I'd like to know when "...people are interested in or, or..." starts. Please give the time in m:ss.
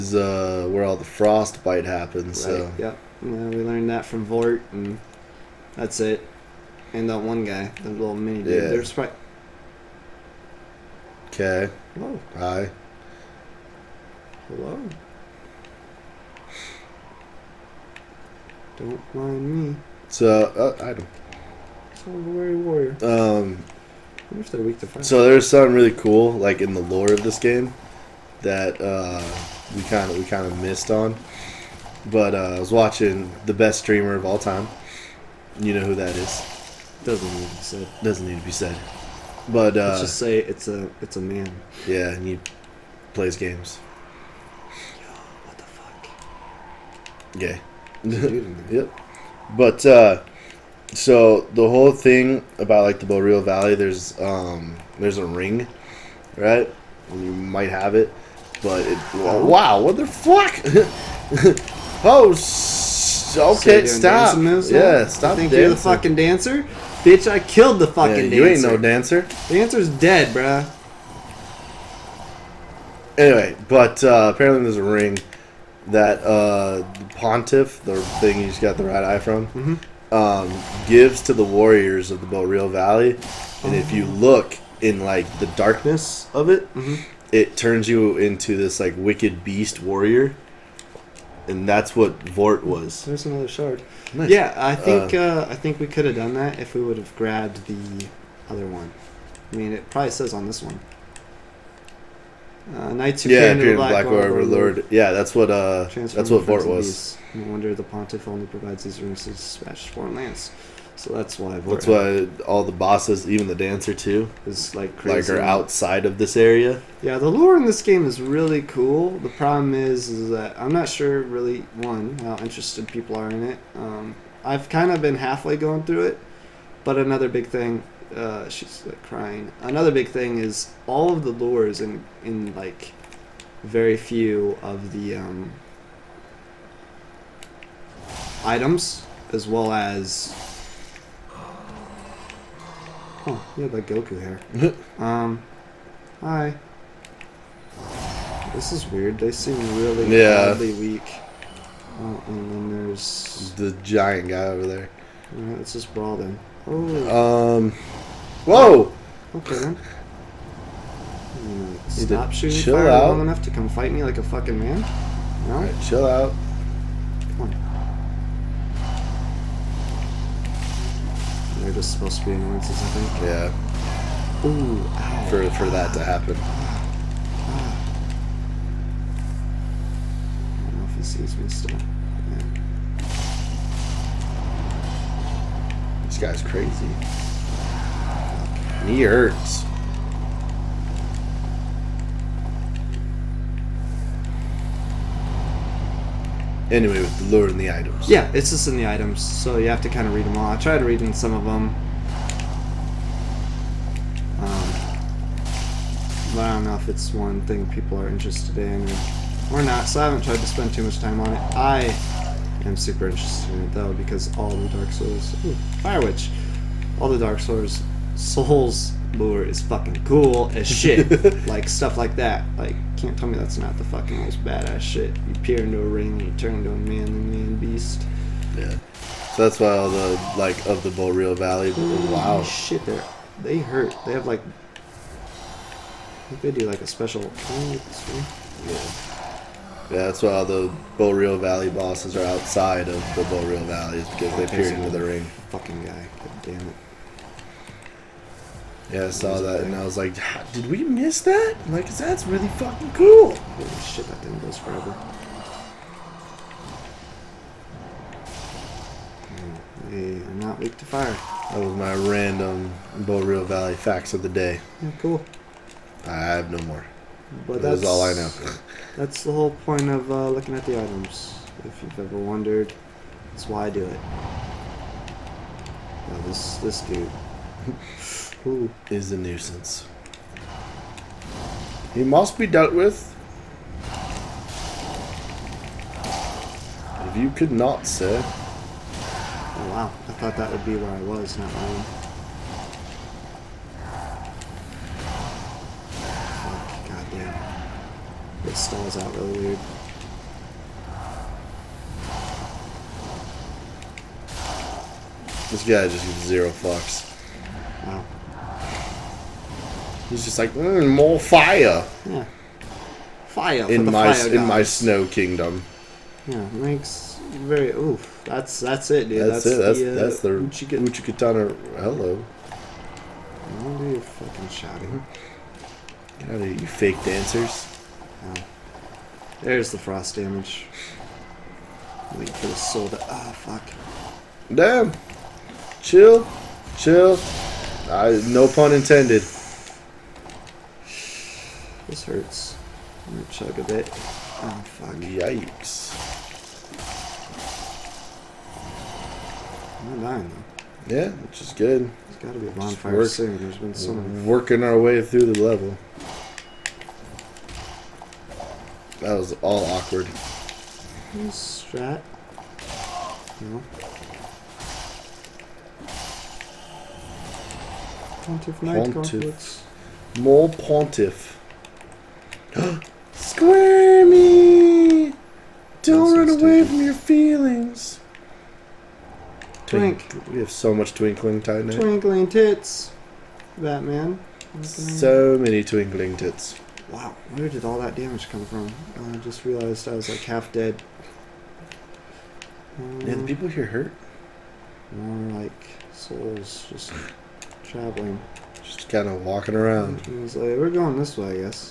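3:27.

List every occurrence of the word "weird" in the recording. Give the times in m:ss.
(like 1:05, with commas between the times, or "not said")
2:28, 4:59.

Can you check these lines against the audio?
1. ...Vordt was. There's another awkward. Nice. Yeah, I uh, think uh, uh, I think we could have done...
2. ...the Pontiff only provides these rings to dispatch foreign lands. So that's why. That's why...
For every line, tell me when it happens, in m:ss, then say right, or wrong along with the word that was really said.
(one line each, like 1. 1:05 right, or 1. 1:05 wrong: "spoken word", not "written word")
1. 1:32 wrong: "shard", not "awkward"
2. 1:47 right.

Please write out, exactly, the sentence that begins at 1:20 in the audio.
um, gives to the warriors of the Boreal Valley.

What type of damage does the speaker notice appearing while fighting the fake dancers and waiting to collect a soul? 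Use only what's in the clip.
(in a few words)
Frost damage.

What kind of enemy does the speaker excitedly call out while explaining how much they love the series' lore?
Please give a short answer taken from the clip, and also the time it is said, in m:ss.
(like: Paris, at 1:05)
Fire Witch, at 3:35.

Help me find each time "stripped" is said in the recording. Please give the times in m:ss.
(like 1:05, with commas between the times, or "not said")
not said.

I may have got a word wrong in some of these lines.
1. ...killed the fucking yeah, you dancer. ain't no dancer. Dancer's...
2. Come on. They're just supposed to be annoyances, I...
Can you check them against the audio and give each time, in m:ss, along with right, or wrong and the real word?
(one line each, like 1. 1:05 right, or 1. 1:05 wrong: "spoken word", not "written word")
1. 1:07 right
2. 2:47 right.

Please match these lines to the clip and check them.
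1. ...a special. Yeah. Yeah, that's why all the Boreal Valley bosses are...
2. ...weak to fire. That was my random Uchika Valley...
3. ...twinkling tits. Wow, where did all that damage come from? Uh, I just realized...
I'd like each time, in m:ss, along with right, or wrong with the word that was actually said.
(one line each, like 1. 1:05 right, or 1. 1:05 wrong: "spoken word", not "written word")
1. 3:56 right
2. 4:20 wrong: "Boreal", not "Uchika"
3. 6:25 right.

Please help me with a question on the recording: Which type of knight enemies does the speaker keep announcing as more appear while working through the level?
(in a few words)
Pontiff Knight.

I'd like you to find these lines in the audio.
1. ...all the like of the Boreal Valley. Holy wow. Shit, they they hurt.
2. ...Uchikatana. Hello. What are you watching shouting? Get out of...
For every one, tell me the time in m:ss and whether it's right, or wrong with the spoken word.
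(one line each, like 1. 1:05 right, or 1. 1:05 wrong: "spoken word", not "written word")
1. 3:49 right
2. 5:20 wrong: "fucking", not "watching".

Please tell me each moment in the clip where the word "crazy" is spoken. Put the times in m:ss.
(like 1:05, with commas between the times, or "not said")
1:54, 3:06.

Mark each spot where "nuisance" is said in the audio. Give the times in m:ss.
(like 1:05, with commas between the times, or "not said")
4:39.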